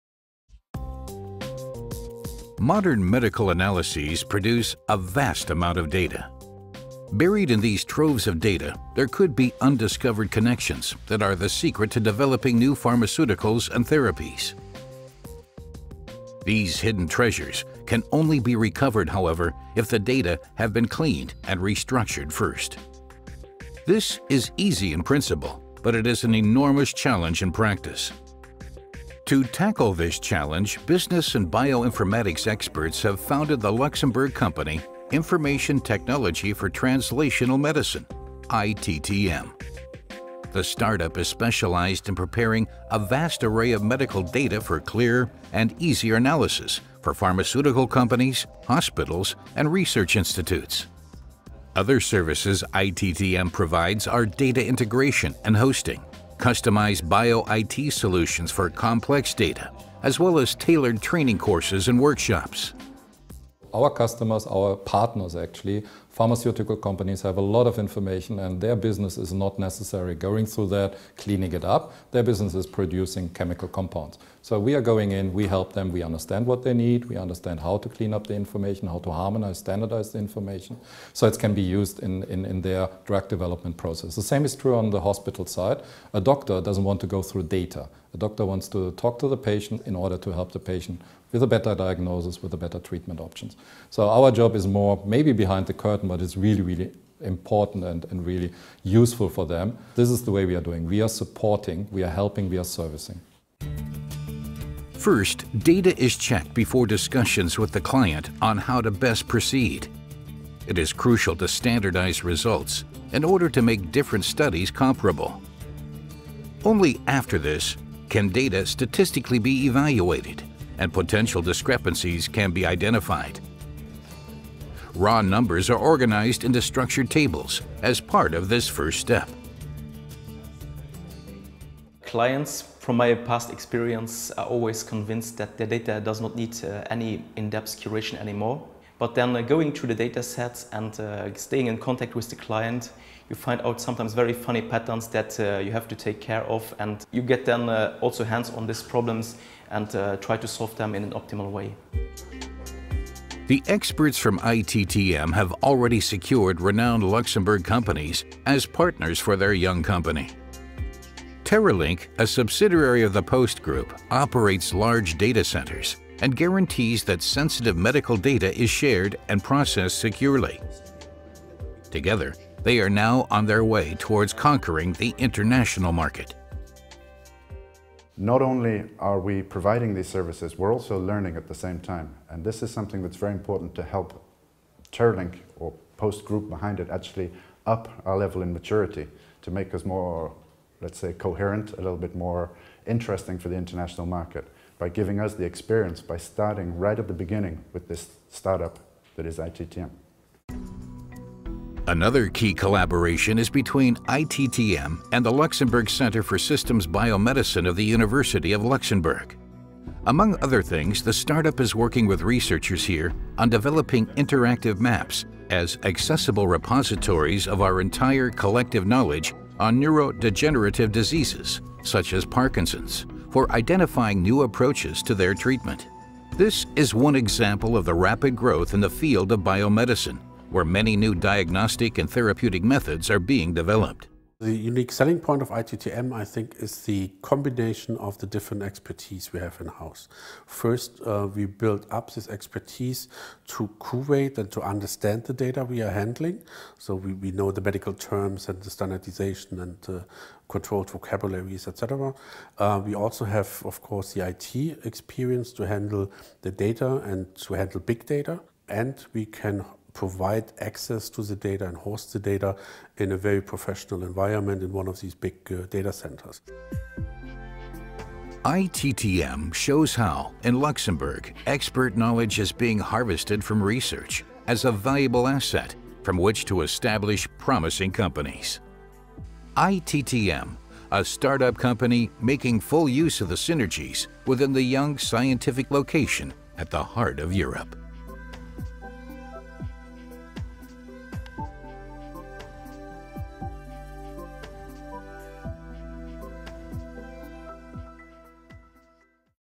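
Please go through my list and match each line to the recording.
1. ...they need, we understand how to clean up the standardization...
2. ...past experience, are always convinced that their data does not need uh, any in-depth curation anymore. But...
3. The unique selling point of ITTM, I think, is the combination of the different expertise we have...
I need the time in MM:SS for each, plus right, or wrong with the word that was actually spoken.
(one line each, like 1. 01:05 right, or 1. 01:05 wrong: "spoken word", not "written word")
1. 01:16 wrong: "information", not "standardization"
2. 02:13 right
3. 03:54 right.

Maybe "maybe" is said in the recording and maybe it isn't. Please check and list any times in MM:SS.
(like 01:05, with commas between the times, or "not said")
01:35.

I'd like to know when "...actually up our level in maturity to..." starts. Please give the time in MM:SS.
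03:06.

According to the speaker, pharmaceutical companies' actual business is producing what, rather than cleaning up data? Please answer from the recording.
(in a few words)
Chemical compounds.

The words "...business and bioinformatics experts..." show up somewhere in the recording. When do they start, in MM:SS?
00:30.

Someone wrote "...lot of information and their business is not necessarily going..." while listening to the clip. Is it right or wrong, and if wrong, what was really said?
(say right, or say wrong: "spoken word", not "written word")
right.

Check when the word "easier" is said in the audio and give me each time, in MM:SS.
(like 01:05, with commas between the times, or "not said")
00:45.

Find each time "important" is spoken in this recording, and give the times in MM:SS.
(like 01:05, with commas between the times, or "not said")
01:37, 03:03.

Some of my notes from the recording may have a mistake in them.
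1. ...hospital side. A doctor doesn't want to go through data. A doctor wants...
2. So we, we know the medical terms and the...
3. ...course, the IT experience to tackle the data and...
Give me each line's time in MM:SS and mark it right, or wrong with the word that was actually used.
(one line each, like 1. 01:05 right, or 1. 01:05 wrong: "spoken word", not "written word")
1. 01:25 right
2. 04:06 right
3. 04:13 wrong: "handle", not "tackle".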